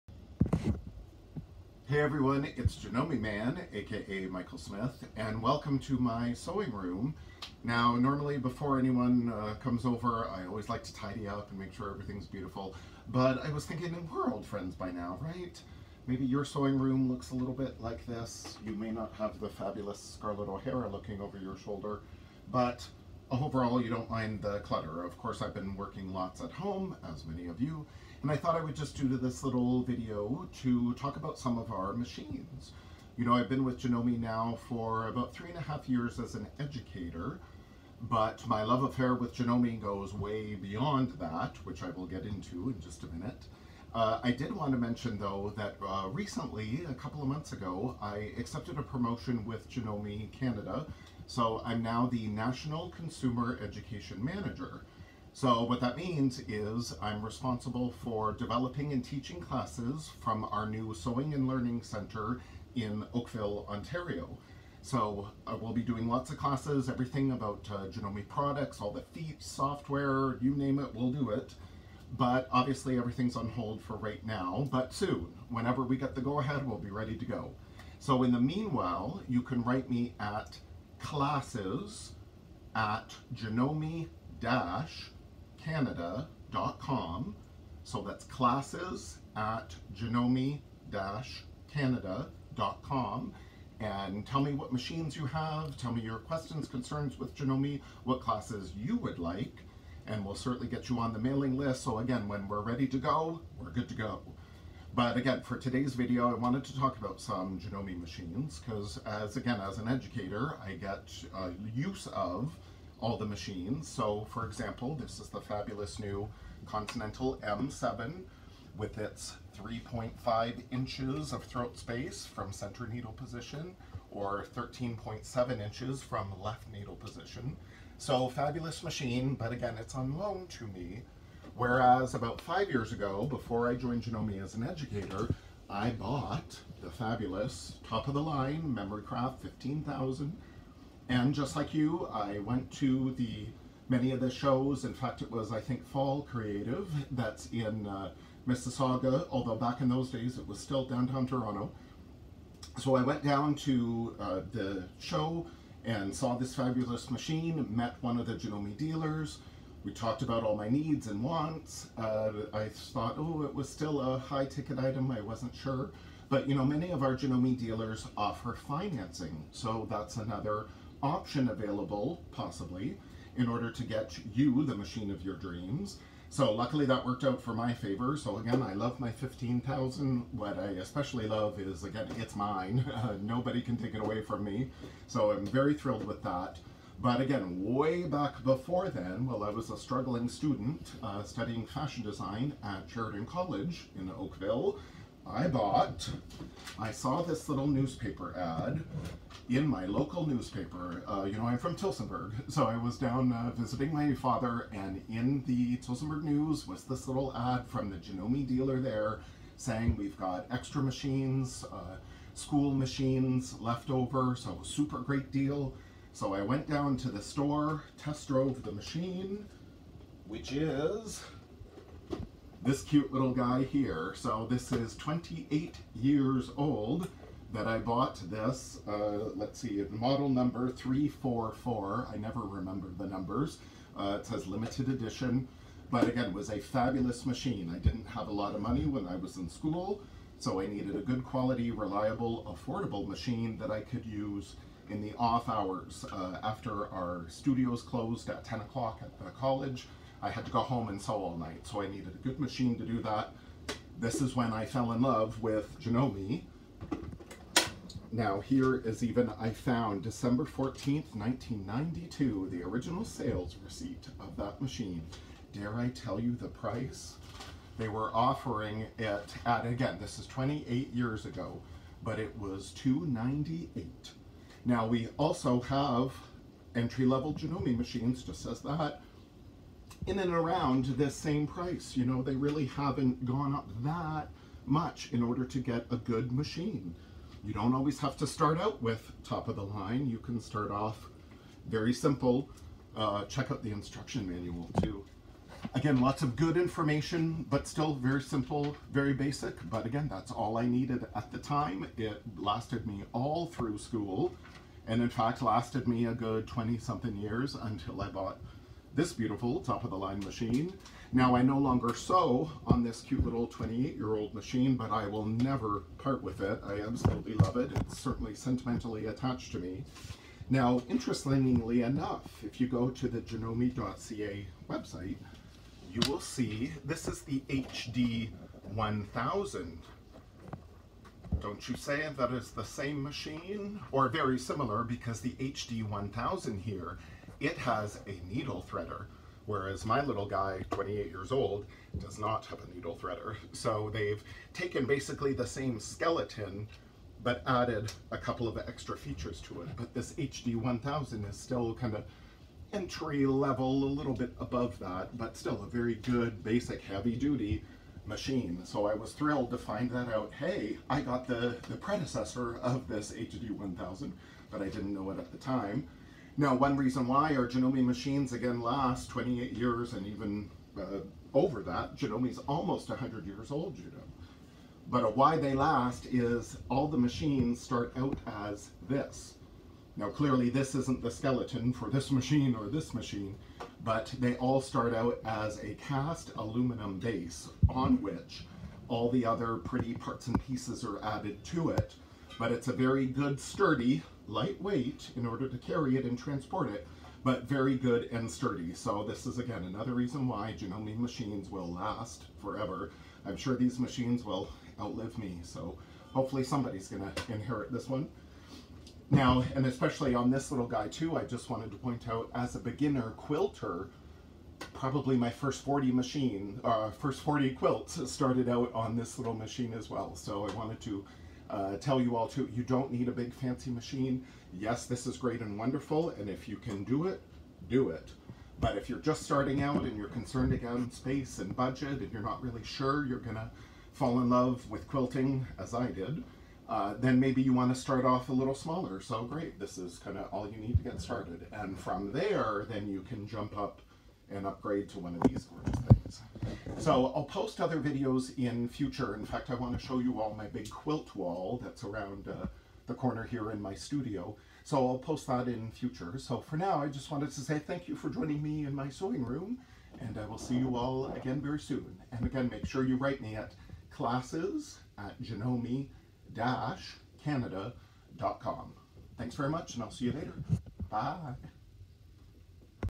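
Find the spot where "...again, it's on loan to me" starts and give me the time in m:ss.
2:09.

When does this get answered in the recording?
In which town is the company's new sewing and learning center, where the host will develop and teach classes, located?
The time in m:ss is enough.
1:03.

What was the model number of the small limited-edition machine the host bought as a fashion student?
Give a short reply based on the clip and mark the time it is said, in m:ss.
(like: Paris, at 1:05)
344, at 3:50.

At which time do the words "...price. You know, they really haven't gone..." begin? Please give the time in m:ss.
4:41.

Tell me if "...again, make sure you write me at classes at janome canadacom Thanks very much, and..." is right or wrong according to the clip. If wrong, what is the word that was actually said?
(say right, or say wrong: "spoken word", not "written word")
right.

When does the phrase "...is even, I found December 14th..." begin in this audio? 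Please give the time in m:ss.
4:18.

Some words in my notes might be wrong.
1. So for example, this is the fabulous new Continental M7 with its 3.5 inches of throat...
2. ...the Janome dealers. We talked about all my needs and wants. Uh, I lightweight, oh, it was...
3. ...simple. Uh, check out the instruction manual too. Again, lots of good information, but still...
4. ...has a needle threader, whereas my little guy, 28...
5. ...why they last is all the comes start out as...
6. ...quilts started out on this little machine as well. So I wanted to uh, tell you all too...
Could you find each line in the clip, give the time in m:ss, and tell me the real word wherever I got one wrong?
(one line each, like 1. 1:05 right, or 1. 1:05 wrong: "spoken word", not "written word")
1. 1:53 right
2. 2:38 wrong: "thought", not "lightweight"
3. 4:51 right
4. 5:37 right
5. 6:15 wrong: "machines", not "comes"
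6. 6:57 right.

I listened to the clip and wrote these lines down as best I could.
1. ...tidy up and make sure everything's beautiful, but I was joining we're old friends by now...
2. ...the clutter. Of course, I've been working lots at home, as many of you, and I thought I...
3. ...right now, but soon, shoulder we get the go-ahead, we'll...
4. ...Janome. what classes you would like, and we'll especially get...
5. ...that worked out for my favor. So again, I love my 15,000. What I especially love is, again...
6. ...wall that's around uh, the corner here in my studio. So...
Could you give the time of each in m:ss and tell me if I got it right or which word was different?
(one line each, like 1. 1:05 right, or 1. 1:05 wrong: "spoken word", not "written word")
1. 0:10 wrong: "thinking", not "joining"
2. 0:24 right
3. 1:13 wrong: "whenever", not "shoulder"
4. 1:37 wrong: "certainly", not "especially"
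5. 2:56 right
6. 7:31 right.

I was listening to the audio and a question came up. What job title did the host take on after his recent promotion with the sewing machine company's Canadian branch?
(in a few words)
National Consumer Education Manager.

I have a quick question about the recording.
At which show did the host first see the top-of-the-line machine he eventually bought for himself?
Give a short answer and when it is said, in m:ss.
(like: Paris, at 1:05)
Fall Creative, at 2:25.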